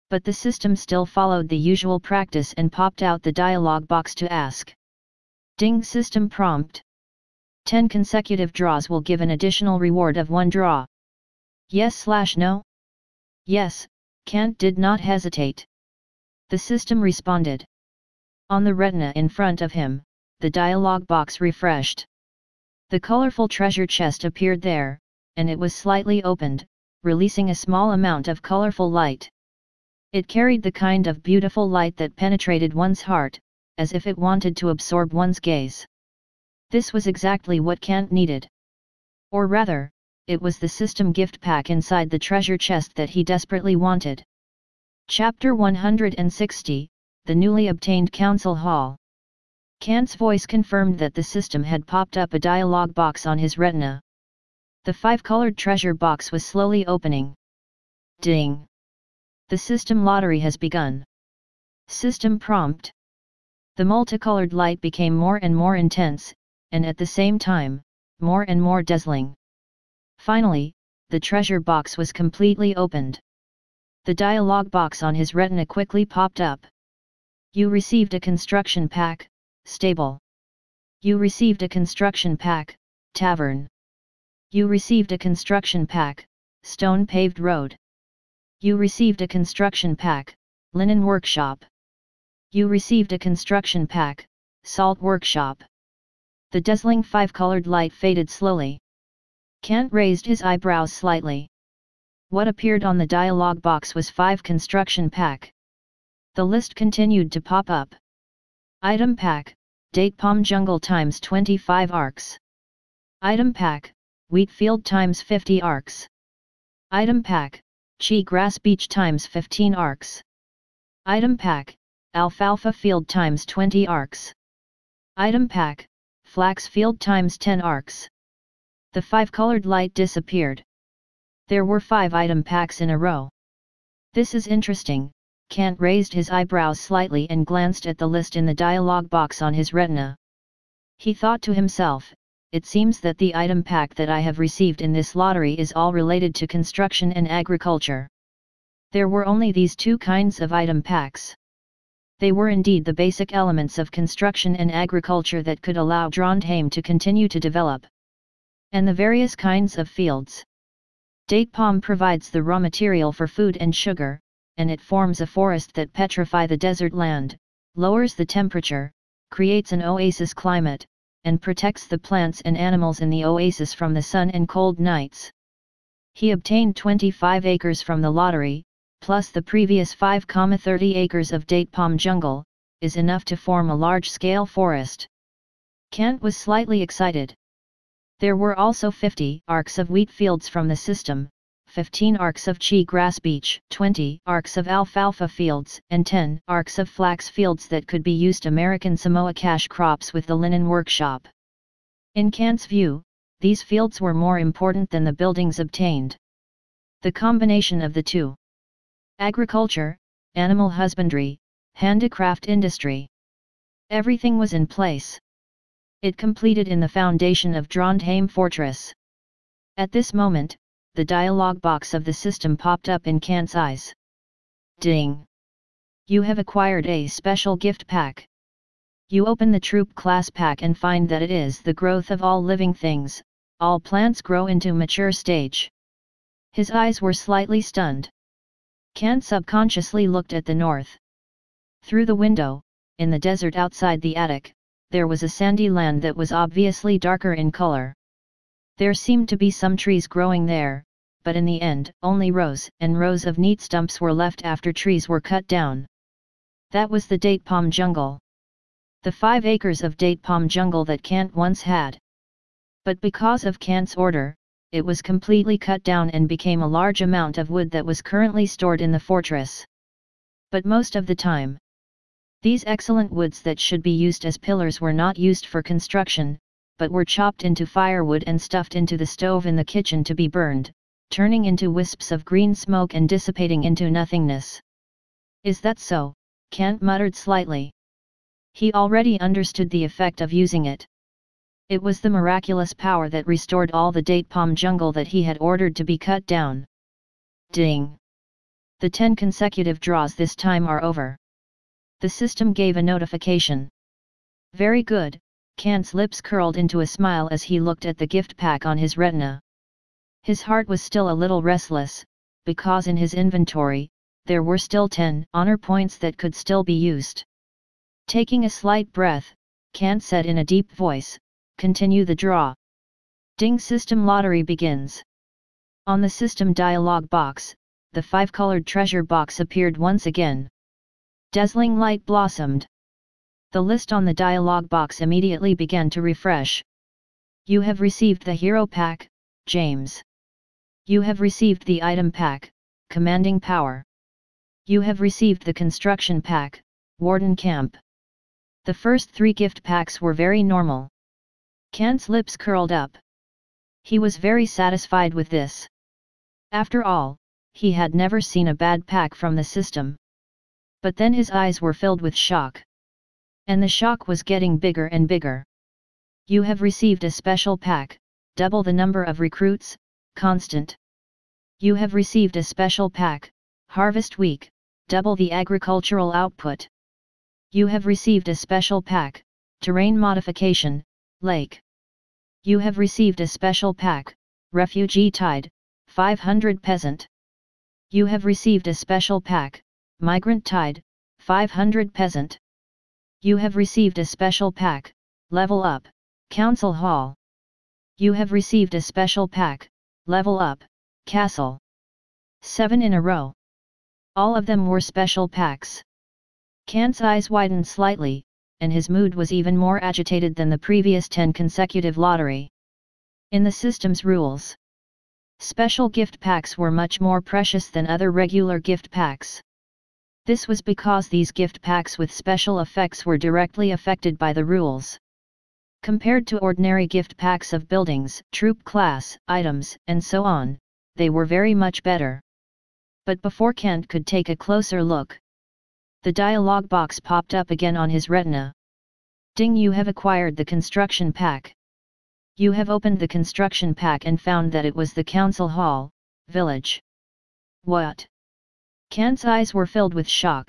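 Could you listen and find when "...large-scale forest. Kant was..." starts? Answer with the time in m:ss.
3:03.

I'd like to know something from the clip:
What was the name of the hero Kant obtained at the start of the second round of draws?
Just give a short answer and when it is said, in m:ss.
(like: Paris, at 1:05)
James, at 5:39.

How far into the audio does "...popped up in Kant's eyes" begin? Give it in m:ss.
3:42.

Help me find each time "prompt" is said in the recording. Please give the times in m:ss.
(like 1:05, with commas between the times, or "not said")
0:06, 1:02.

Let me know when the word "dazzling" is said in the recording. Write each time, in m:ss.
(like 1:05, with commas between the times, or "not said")
1:08, 1:36, 5:31.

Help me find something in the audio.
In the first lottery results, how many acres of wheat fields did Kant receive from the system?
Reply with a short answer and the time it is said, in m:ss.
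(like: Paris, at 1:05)
50, at 1:54.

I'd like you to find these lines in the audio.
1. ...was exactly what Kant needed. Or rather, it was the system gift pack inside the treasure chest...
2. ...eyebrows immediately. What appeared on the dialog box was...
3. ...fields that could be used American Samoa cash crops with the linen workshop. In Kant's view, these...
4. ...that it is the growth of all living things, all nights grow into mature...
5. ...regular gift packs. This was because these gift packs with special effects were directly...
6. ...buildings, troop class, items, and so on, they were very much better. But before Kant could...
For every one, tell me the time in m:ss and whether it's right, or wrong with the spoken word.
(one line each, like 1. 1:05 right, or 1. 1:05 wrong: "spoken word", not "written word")
1. 0:36 right
2. 1:40 wrong: "slightly", not "immediately"
3. 3:17 right
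4. 3:51 wrong: "plants", not "nights"
5. 6:58 right
6. 7:07 right.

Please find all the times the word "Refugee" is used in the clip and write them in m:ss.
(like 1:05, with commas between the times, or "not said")
6:24.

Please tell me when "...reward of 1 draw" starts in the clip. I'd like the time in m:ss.
0:09.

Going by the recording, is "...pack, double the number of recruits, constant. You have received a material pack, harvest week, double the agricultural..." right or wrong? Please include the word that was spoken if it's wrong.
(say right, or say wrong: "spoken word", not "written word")
wrong: "special", not "material".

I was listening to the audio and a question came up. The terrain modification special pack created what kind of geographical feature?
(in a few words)
Lake.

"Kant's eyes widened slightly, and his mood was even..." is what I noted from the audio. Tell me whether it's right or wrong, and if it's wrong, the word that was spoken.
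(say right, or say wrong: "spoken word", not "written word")
right.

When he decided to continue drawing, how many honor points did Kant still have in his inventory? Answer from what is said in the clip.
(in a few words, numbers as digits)
10.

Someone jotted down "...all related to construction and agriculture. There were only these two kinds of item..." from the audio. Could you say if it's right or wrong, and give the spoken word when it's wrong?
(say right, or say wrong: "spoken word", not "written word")
right.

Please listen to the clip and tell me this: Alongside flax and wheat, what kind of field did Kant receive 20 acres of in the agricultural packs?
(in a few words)
alfalfa field.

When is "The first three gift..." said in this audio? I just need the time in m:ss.
5:48.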